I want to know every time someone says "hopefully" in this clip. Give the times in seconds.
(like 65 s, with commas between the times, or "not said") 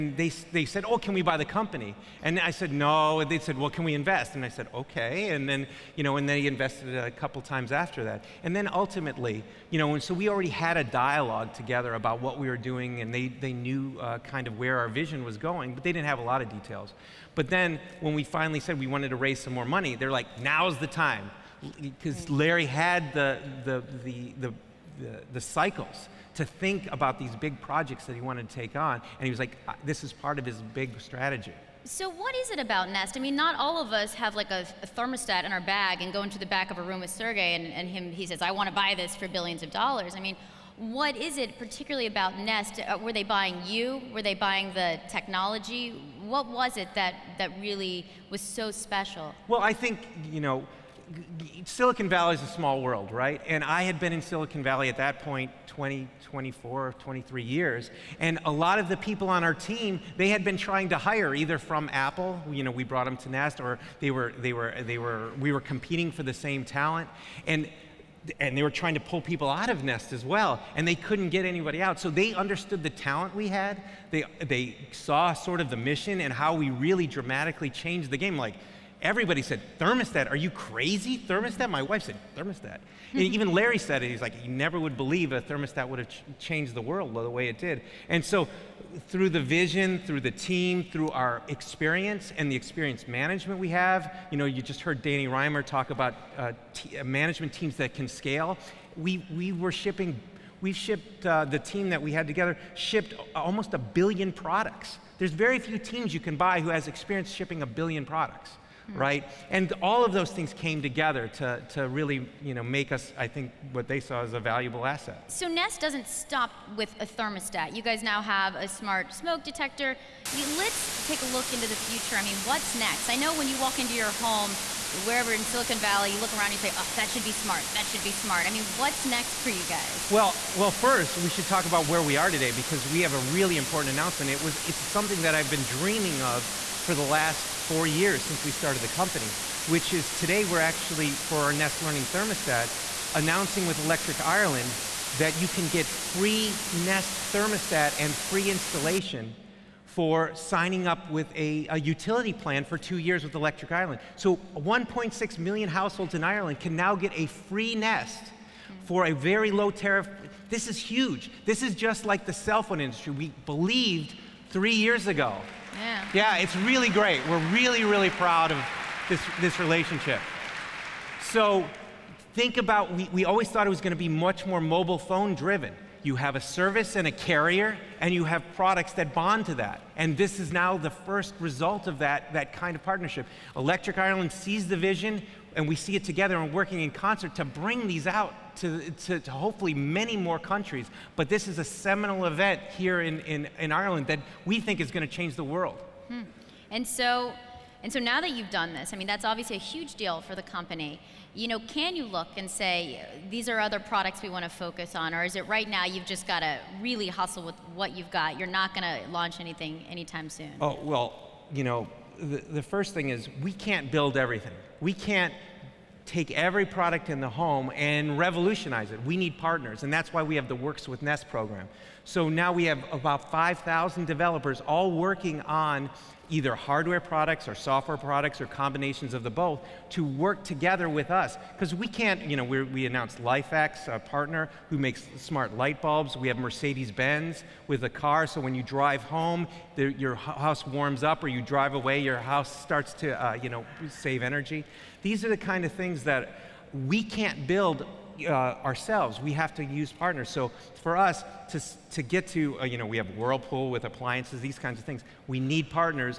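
189 s.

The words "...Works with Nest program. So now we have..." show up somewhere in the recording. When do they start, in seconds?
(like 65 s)
220 s.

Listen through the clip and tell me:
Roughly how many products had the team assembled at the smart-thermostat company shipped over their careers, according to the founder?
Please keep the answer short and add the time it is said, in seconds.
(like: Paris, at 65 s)
almost a billion, at 103 s.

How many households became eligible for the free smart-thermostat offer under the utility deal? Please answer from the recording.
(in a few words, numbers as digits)
1.6 million.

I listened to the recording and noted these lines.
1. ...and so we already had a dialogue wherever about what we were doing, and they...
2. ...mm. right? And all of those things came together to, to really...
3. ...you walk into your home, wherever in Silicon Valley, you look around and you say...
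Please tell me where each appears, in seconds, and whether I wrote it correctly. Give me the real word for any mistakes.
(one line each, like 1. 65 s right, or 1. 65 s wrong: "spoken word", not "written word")
1. 9 s wrong: "together", not "wherever"
2. 108 s right
3. 123 s right.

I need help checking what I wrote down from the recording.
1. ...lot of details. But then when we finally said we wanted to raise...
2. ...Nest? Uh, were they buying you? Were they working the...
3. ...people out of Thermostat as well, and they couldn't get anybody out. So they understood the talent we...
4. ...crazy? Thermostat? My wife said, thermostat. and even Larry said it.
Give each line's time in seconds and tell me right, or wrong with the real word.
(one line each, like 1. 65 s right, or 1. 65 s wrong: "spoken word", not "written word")
1. 16 s right
2. 42 s wrong: "buying", not "working"
3. 69 s wrong: "Nest", not "Thermostat"
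4. 80 s right.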